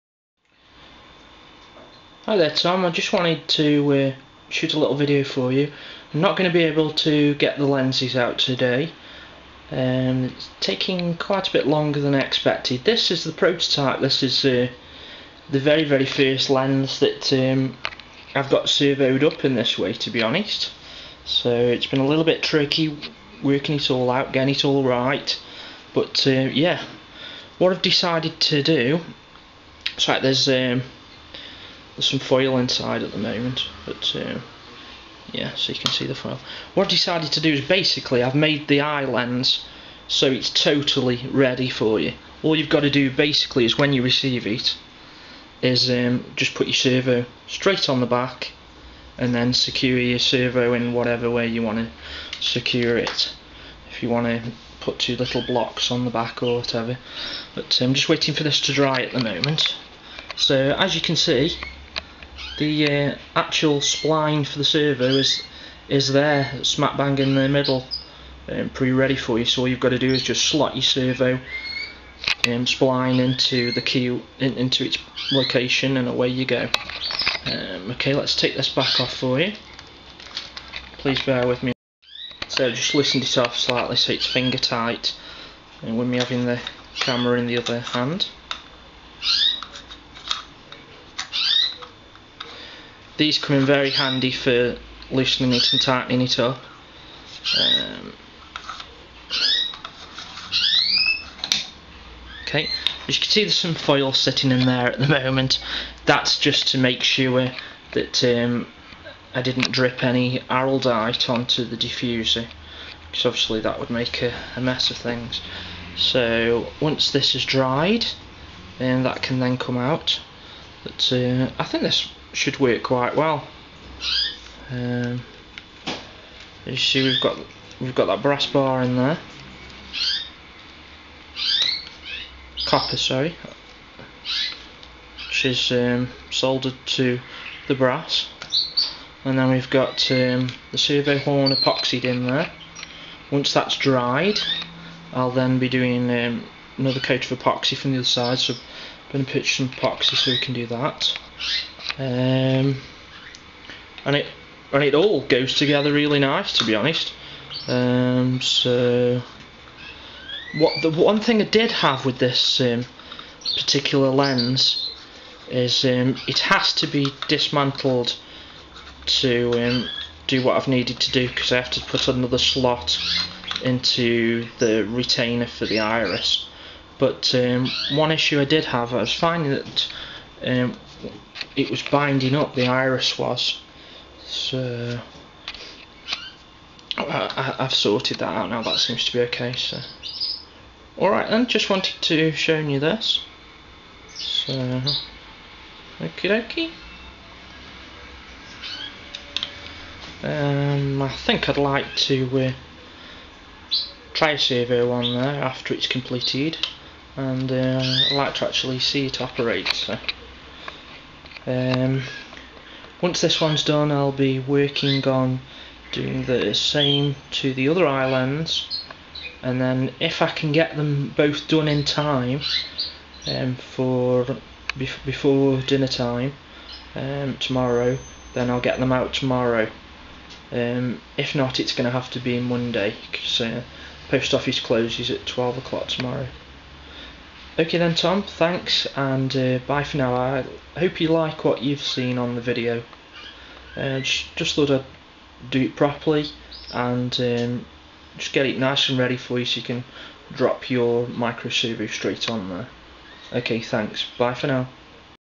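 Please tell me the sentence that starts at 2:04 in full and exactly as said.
Um, you see we've got we've got that brass bar in there.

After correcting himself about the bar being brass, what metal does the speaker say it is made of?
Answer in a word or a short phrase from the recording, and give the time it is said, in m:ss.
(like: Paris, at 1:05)
Copper, at 2:12.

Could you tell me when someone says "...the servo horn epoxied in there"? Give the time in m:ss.
2:20.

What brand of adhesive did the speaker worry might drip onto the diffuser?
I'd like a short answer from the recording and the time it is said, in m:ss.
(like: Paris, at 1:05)
Araldite, at 1:50.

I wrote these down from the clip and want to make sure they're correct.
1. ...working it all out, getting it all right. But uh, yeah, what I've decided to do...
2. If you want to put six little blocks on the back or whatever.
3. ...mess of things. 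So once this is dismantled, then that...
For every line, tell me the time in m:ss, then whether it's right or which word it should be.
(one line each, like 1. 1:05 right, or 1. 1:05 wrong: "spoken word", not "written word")
1. 0:23 right
2. 0:53 wrong: "two", not "six"
3. 1:54 wrong: "dried", not "dismantled".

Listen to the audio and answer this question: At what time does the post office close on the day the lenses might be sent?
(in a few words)
12 o'clock.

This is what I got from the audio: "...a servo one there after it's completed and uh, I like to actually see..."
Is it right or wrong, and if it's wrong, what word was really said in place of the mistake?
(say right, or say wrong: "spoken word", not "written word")
right.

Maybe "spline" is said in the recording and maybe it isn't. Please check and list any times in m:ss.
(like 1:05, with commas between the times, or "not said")
1:03, 1:12.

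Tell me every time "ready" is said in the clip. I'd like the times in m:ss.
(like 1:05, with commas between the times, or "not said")
0:41, 1:08, 4:08.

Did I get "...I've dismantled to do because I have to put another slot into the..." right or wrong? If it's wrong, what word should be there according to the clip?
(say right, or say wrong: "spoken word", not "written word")
wrong: "needed", not "dismantled".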